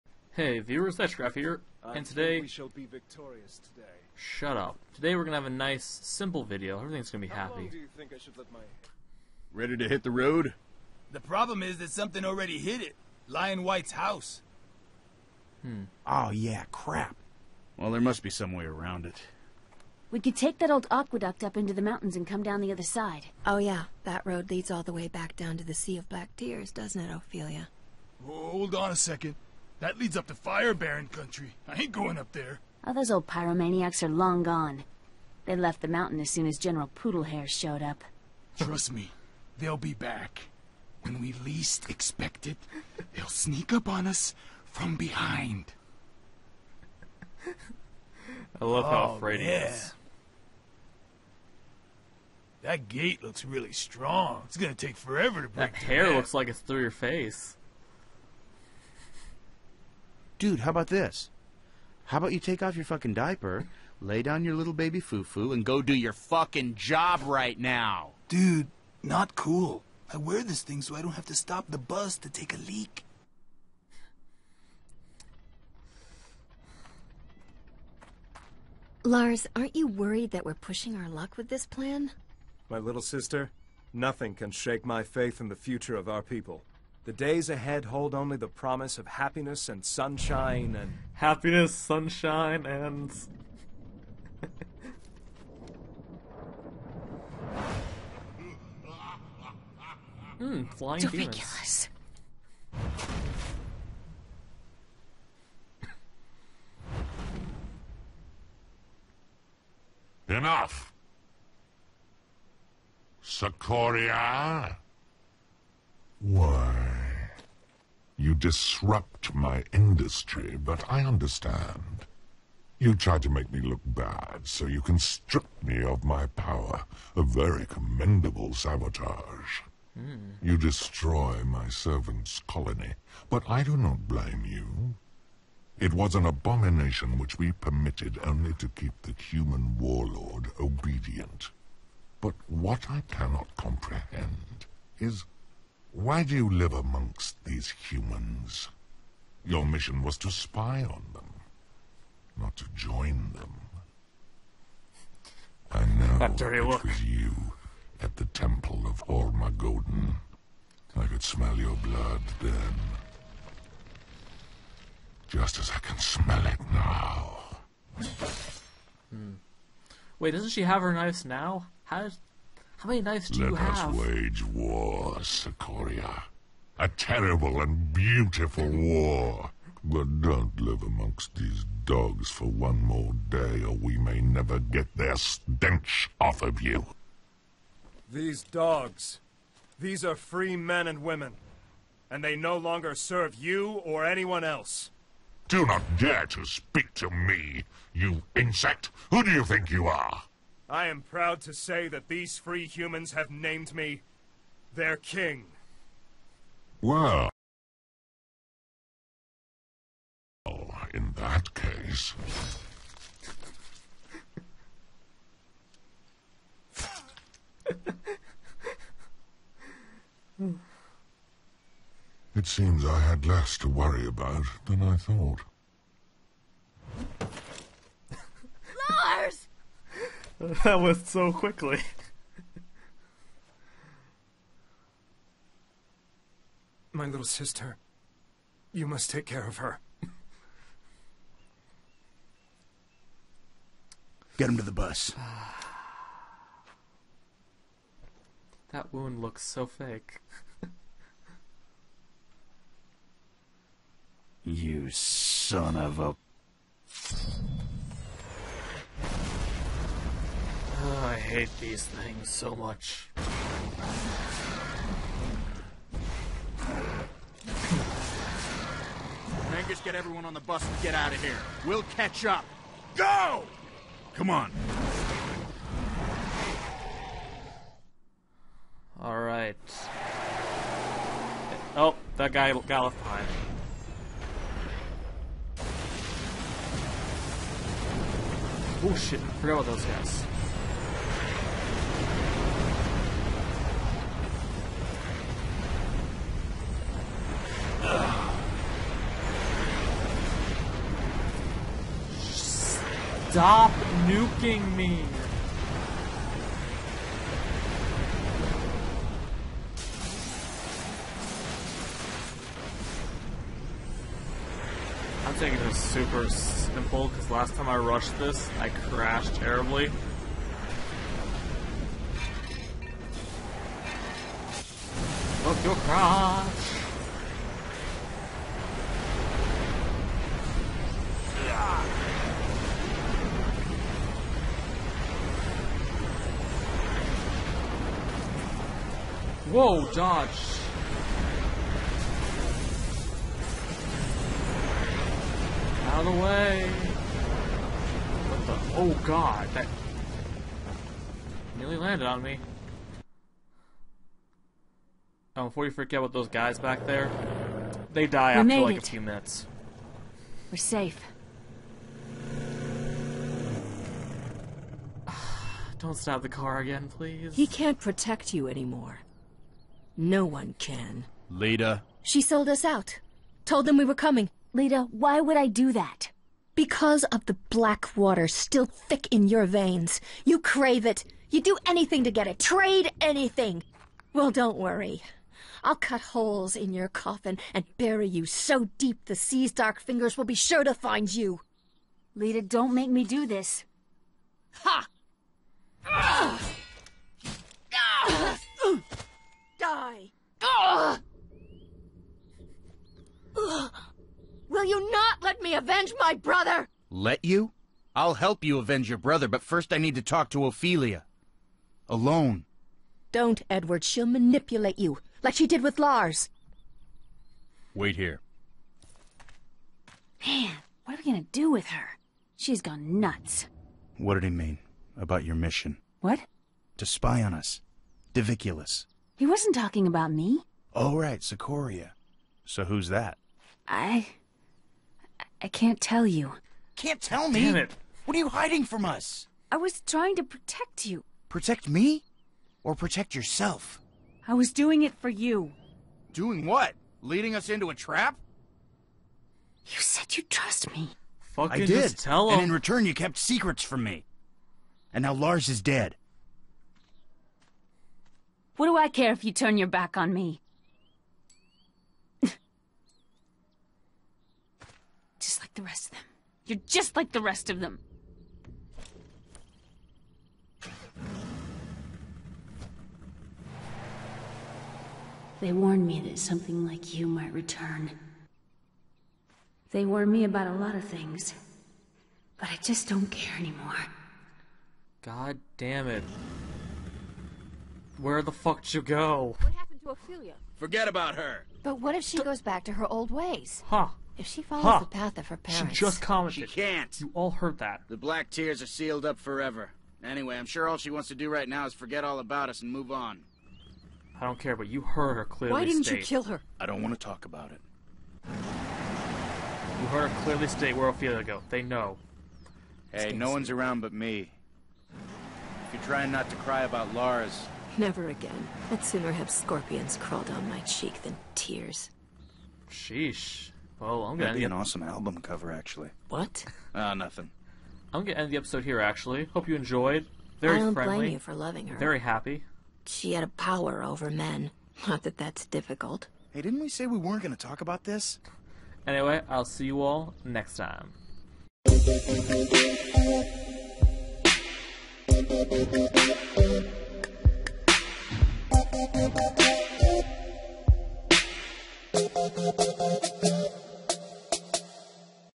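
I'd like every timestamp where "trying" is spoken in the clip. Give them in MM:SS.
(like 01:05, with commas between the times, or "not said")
07:19, 08:35.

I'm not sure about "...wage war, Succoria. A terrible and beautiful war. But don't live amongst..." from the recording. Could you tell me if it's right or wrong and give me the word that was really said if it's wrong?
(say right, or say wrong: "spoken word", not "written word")
right.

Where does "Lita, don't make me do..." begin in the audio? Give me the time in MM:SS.
06:32.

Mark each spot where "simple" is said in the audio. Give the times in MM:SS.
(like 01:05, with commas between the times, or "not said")
00:05, 05:16.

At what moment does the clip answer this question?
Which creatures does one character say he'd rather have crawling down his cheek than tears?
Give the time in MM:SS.
08:39.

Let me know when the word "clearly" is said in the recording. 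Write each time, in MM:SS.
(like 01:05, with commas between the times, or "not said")
08:25, 08:30.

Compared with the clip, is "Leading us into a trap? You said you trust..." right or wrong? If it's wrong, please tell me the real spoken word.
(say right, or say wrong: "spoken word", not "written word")
right.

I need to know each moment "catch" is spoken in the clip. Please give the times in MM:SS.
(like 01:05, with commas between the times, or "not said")
04:31.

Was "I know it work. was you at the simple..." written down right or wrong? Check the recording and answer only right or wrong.
wrong.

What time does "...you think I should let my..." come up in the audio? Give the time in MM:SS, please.
00:07.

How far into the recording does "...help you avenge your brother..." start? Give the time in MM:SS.
06:48.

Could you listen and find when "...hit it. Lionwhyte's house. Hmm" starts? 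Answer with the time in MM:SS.
00:12.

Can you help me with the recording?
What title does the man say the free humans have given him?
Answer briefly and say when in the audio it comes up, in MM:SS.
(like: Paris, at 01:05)
King, at 03:24.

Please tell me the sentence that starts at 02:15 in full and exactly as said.
It was an abomination which we permitted only to keep the human warlord obedient.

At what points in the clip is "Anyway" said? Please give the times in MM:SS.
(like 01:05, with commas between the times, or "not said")
08:20, 08:58.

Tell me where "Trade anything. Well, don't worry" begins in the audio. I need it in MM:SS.
06:22.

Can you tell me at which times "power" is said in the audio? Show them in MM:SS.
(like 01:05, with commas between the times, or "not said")
02:06, 08:53.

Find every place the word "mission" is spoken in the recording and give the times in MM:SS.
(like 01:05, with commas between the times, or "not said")
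02:29, 07:05.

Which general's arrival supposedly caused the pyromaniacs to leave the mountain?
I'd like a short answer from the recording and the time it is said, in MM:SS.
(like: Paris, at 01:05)
General Poodlehair, at 00:36.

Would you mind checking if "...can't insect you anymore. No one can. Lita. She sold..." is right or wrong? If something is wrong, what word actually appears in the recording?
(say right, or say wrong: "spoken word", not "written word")
wrong: "protect", not "insect".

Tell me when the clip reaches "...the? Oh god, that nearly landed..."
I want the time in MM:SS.
05:48.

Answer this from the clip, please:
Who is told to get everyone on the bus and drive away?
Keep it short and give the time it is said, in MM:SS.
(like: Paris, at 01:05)
Angus, at 04:29.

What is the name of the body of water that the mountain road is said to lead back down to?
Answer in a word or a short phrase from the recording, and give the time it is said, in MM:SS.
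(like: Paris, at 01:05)
Sea of Black Tears, at 00:25.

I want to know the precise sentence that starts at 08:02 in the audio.
But I just don't care anymore.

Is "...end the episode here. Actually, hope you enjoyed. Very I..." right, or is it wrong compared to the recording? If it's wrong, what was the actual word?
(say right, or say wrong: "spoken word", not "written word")
right.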